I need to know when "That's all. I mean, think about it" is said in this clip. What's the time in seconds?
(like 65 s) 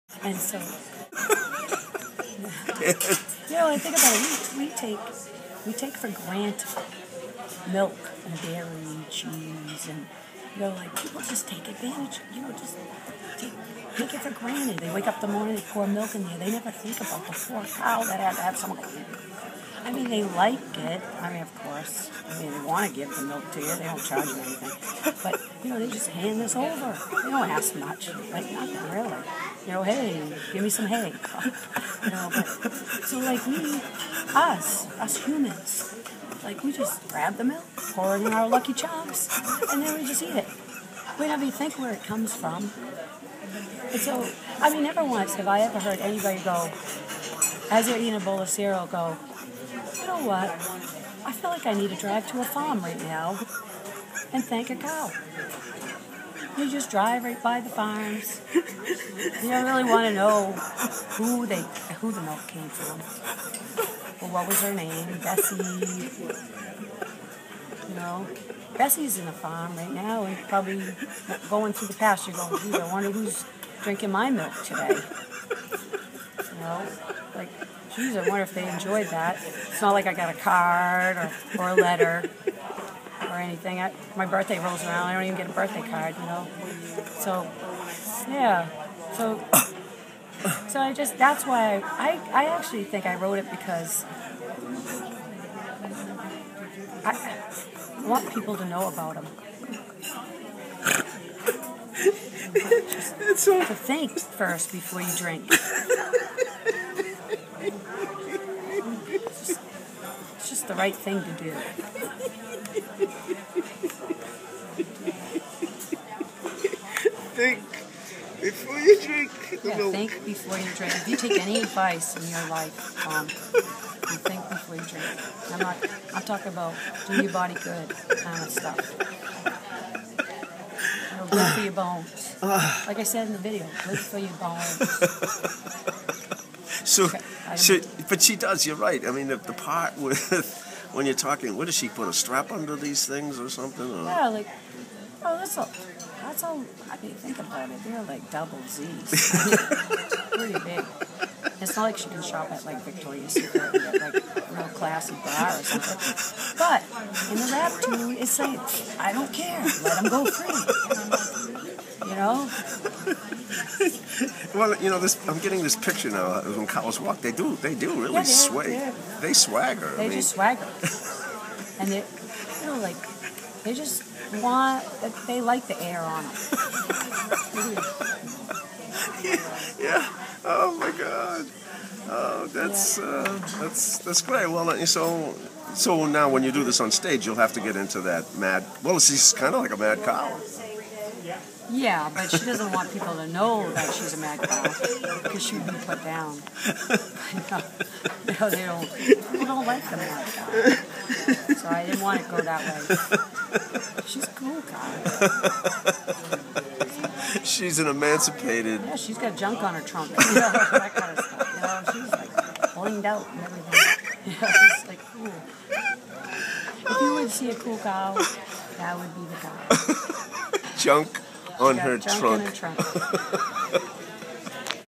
146 s.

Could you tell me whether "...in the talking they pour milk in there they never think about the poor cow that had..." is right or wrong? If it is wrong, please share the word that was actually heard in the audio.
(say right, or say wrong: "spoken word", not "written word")
wrong: "morning", not "talking".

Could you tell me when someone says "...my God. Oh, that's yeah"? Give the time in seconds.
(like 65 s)
180 s.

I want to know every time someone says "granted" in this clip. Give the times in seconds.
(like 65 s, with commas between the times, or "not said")
6 s, 14 s.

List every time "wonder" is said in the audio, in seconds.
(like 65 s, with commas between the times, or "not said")
72 s, 78 s.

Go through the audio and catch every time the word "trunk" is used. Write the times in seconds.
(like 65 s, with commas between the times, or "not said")
209 s, 222 s.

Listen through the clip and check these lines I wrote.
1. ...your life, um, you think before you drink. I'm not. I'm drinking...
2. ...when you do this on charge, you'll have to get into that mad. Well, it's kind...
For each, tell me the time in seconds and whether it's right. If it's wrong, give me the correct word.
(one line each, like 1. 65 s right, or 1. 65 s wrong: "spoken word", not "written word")
1. 122 s wrong: "talking", not "drinking"
2. 186 s wrong: "stage", not "charge".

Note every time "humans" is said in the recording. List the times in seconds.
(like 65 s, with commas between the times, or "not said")
35 s.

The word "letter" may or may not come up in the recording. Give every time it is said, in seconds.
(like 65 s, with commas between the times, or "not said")
81 s.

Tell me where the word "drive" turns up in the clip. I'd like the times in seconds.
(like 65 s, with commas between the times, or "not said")
51 s, 56 s.